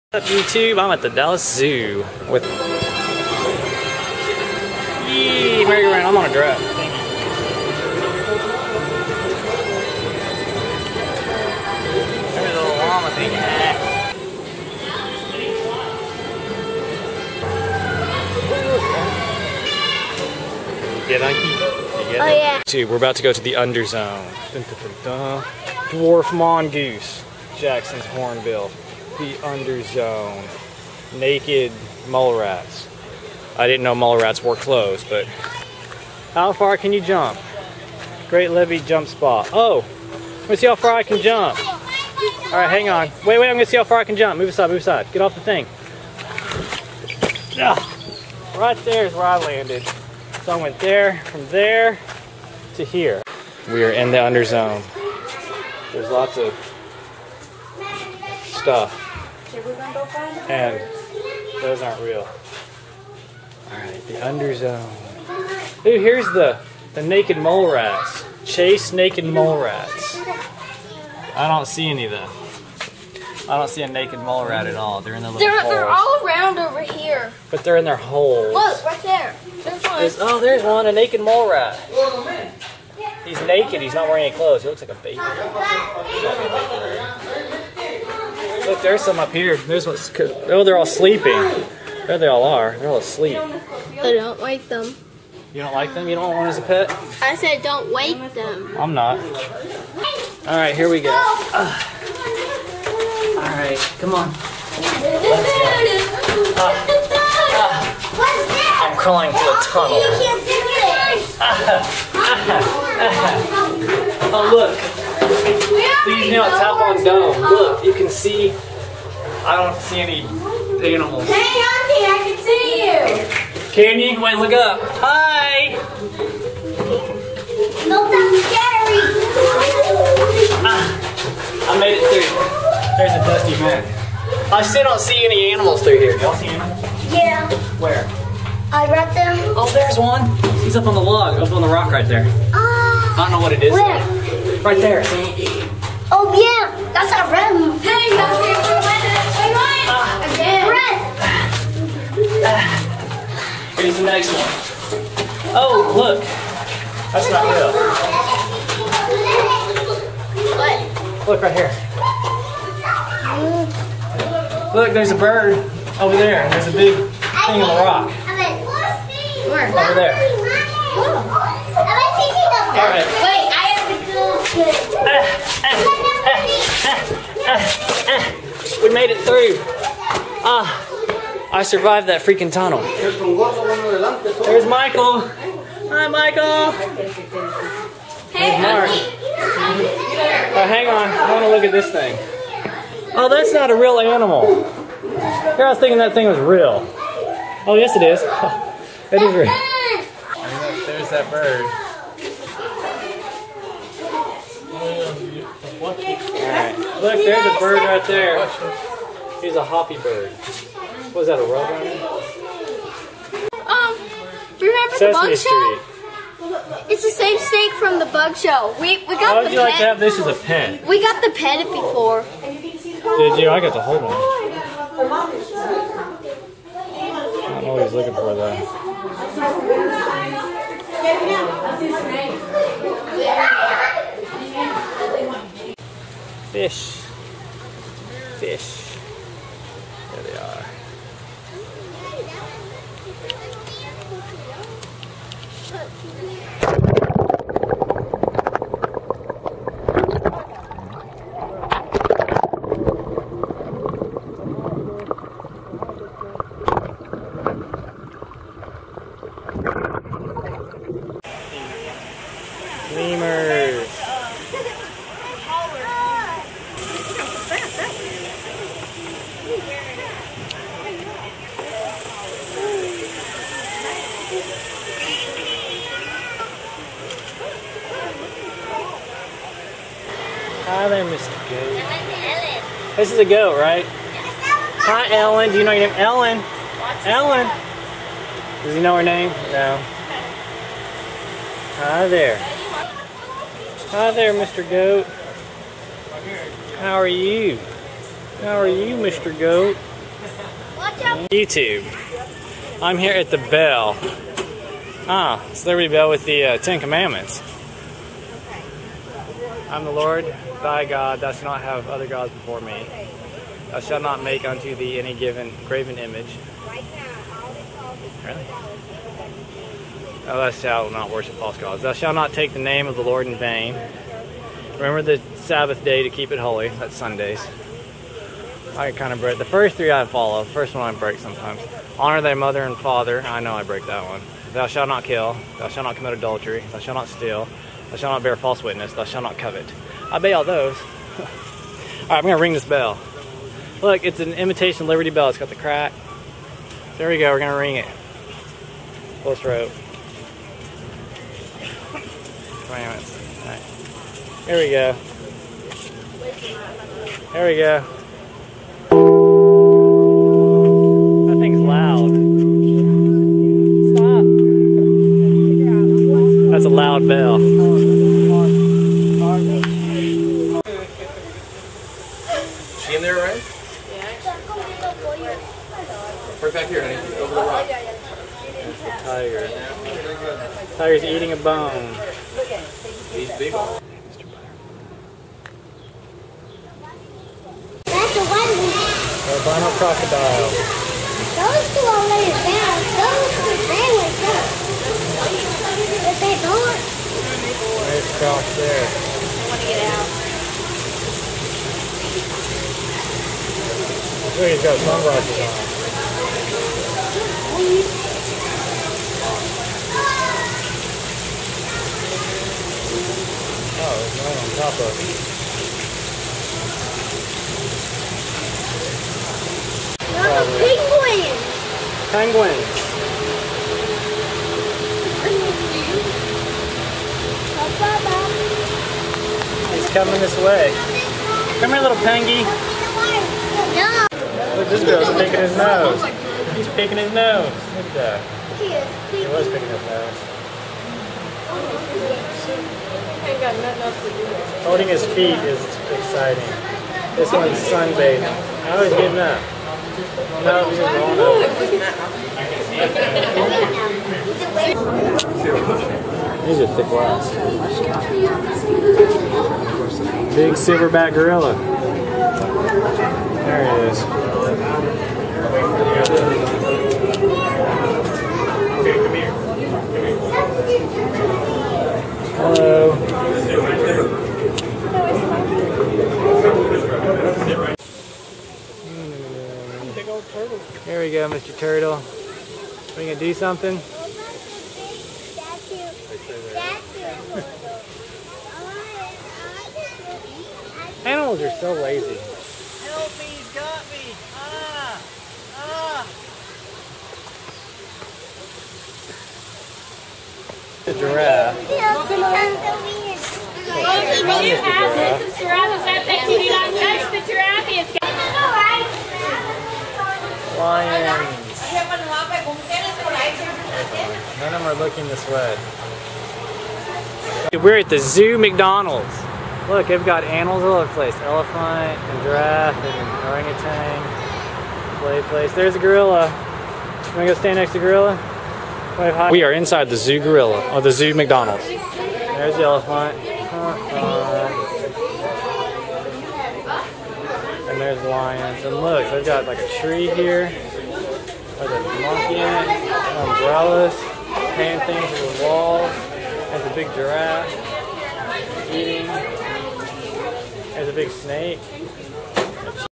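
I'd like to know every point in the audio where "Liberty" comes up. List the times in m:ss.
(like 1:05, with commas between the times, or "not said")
5:05, 5:44.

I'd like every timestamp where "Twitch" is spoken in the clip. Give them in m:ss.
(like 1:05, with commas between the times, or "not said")
not said.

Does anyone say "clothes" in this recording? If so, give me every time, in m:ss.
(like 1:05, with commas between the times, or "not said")
0:34, 1:24.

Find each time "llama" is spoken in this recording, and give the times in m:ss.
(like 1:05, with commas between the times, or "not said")
0:12.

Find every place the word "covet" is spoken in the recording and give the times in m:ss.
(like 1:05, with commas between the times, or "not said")
5:39.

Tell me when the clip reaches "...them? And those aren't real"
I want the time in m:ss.
1:00.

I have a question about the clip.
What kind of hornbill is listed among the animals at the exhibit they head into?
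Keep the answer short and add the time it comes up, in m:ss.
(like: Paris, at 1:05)
Jackson's hornbill, at 0:27.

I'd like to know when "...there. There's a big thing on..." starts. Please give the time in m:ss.
2:46.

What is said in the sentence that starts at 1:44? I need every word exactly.
Uh, uh, I'm crawling through a tunnel.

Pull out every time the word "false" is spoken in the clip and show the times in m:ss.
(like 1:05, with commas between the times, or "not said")
5:21, 5:38.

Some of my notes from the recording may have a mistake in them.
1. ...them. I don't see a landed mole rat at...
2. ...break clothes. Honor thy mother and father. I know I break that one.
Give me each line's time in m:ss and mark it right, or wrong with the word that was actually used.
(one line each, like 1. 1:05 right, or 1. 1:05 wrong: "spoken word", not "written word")
1. 1:12 wrong: "naked", not "landed"
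2. 5:30 wrong: "sometimes", not "clothes".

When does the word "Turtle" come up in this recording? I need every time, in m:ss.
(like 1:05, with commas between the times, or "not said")
8:01.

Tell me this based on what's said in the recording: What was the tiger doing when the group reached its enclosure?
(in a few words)
eating a bone.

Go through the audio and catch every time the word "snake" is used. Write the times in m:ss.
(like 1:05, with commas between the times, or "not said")
3:37, 9:11.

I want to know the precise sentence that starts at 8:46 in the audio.
You wanna go stand next to gorilla?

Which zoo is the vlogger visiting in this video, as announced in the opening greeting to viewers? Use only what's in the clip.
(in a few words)
Dallas Zoo.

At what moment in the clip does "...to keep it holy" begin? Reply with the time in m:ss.
5:26.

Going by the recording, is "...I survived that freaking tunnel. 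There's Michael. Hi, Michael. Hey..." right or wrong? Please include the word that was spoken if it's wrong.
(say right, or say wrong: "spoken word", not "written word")
right.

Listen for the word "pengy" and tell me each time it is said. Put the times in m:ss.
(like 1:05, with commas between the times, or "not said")
7:11.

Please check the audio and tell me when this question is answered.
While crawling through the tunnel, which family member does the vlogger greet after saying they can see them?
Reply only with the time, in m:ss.
2:01.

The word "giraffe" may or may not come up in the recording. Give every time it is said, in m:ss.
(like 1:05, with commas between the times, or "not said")
8:20, 8:42, 9:06.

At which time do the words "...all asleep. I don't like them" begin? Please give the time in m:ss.
1:32.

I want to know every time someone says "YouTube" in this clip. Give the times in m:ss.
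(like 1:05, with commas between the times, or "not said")
0:00, 5:01.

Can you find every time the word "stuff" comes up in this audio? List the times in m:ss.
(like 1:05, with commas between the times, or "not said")
0:58.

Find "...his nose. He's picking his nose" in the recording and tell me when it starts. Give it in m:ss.
7:15.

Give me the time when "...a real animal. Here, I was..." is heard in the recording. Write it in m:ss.
3:13.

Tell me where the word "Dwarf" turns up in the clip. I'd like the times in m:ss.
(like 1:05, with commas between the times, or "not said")
0:25.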